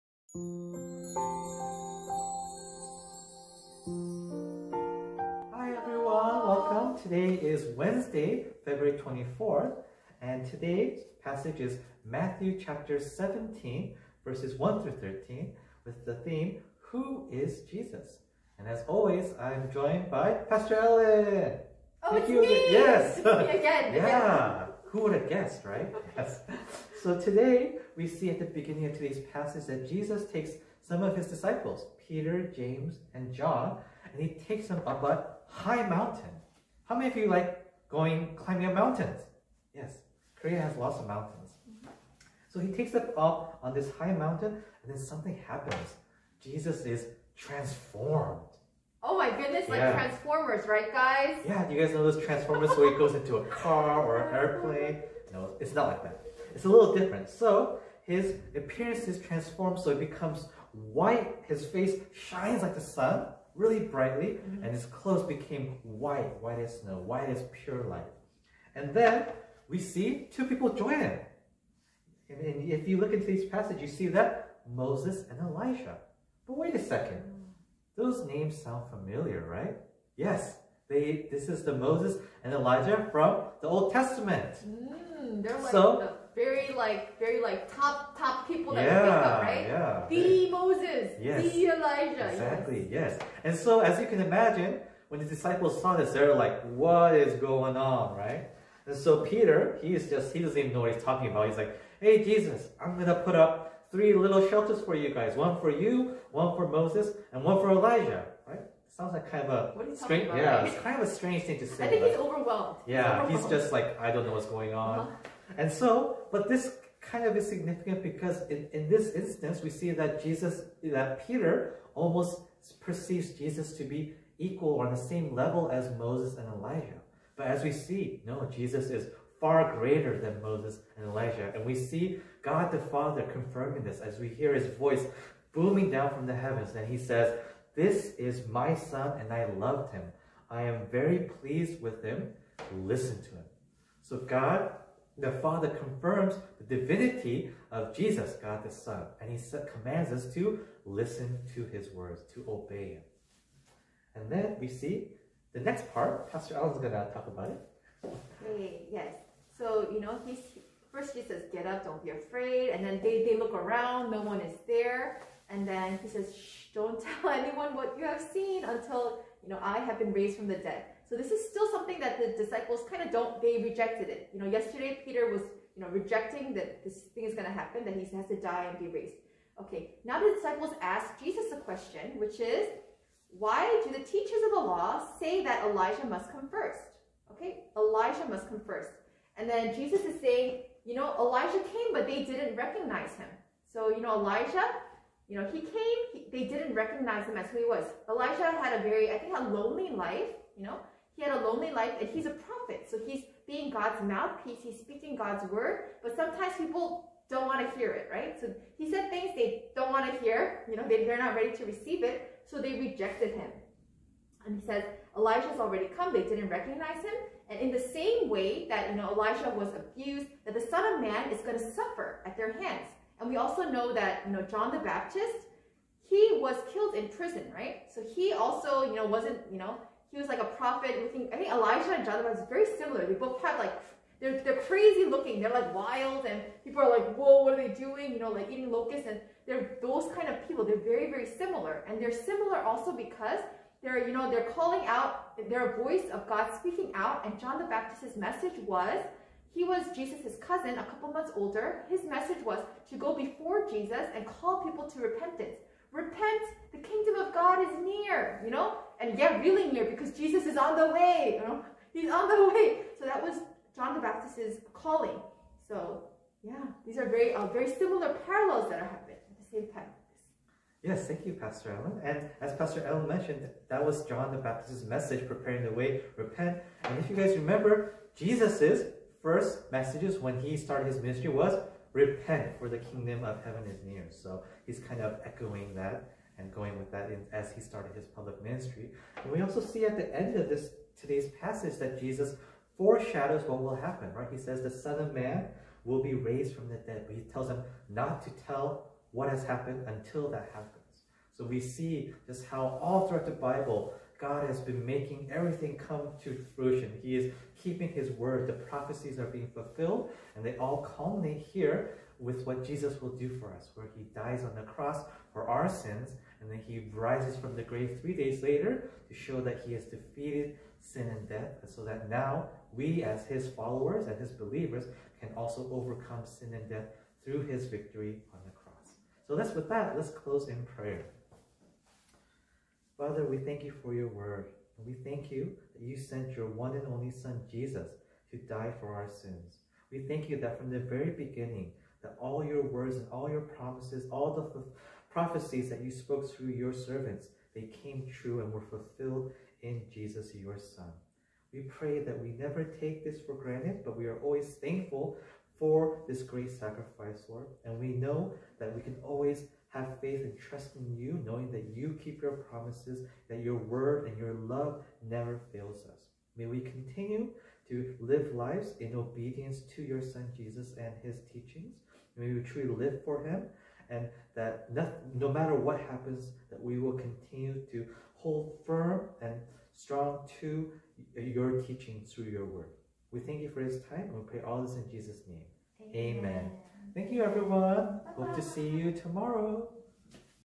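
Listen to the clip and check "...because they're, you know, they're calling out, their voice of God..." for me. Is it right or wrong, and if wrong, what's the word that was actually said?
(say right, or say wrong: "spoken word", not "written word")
right.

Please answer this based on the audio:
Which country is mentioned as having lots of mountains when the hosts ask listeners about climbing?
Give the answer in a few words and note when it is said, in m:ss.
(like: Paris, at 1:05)
Korea, at 0:40.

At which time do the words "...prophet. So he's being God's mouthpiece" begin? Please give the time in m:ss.
3:22.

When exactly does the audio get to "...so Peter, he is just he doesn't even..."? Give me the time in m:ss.
1:38.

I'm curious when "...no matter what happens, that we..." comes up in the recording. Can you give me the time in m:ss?
6:15.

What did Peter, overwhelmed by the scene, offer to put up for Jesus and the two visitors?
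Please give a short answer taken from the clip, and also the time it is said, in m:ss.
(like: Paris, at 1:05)
three little shelters, at 1:43.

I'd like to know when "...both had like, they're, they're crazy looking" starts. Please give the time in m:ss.
3:53.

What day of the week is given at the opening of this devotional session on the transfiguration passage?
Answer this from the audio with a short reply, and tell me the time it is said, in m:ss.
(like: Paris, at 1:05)
Wednesday, at 0:07.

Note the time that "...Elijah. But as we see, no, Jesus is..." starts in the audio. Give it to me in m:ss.
2:06.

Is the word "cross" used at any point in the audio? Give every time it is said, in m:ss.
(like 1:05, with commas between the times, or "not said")
5:14, 5:28.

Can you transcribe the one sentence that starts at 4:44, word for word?
So he's kind of echoing that and going with that as he started his public ministry.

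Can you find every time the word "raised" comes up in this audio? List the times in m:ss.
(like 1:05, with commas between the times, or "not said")
2:50, 2:58, 4:56.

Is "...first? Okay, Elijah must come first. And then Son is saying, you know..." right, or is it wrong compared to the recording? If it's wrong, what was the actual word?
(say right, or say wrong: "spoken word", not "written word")
wrong: "Jesus", not "Son".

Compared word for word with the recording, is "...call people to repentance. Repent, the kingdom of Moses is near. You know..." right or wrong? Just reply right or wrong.
wrong.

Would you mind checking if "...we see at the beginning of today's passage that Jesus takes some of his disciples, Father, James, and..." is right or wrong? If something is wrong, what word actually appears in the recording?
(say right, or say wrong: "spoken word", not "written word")
wrong: "Peter", not "Father".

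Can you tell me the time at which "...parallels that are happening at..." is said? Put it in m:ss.
4:28.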